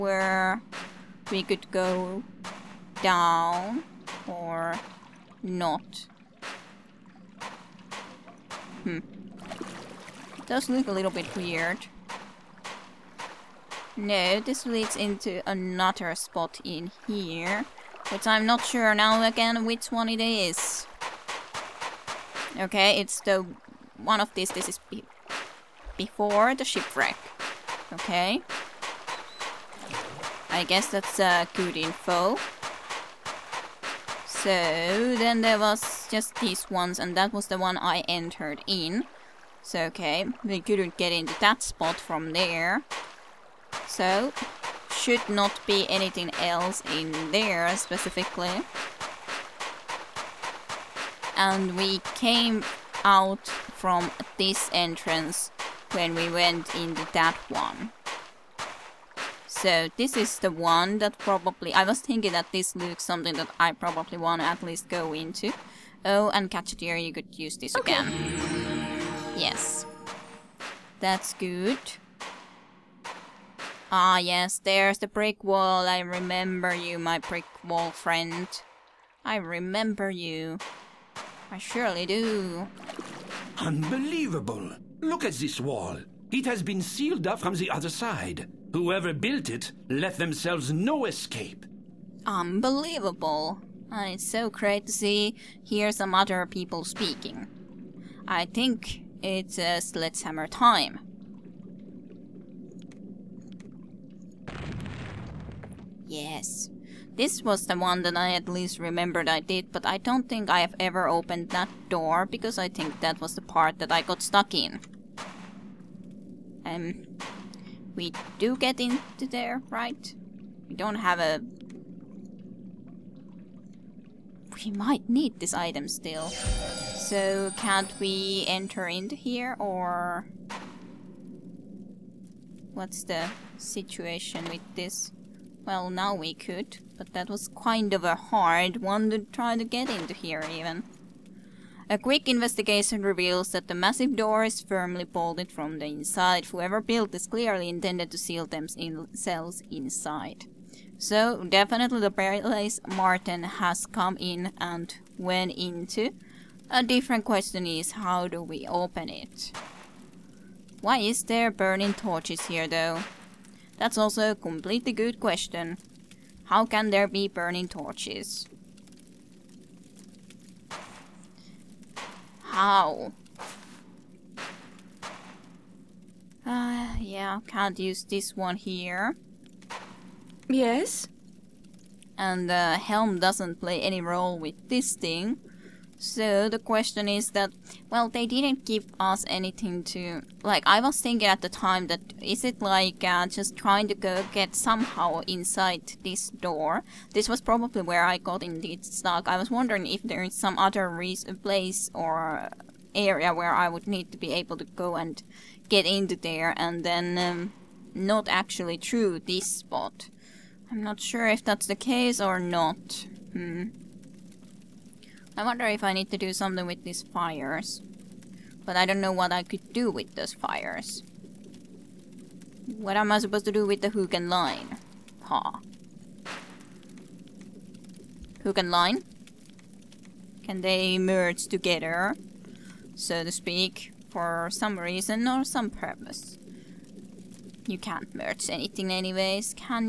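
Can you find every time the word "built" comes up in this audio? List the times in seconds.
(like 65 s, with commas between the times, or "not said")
89 s, 146 s.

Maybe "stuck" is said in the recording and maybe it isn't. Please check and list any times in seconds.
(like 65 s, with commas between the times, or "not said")
114 s, 198 s.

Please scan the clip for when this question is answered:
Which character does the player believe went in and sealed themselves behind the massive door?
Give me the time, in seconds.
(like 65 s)
152 s.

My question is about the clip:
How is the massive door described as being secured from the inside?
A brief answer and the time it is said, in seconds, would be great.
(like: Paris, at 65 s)
firmly bolted, at 144 s.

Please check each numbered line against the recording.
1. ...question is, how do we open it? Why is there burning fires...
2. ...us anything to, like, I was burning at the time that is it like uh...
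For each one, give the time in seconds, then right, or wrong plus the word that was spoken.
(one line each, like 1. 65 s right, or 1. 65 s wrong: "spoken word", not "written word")
1. 157 s wrong: "torches", not "fires"
2. 188 s wrong: "thinking", not "burning".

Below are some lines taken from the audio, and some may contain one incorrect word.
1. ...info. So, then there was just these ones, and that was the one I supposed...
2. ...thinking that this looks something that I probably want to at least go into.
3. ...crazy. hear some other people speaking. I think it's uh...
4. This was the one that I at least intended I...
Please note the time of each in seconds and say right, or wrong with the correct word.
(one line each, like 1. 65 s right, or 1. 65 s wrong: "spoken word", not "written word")
1. 31 s wrong: "entered", not "supposed"
2. 61 s right
3. 94 s right
4. 107 s wrong: "remembered", not "intended".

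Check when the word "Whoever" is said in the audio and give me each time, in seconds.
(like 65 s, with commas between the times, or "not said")
88 s, 146 s.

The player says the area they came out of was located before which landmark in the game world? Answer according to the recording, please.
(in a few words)
the shipwreck.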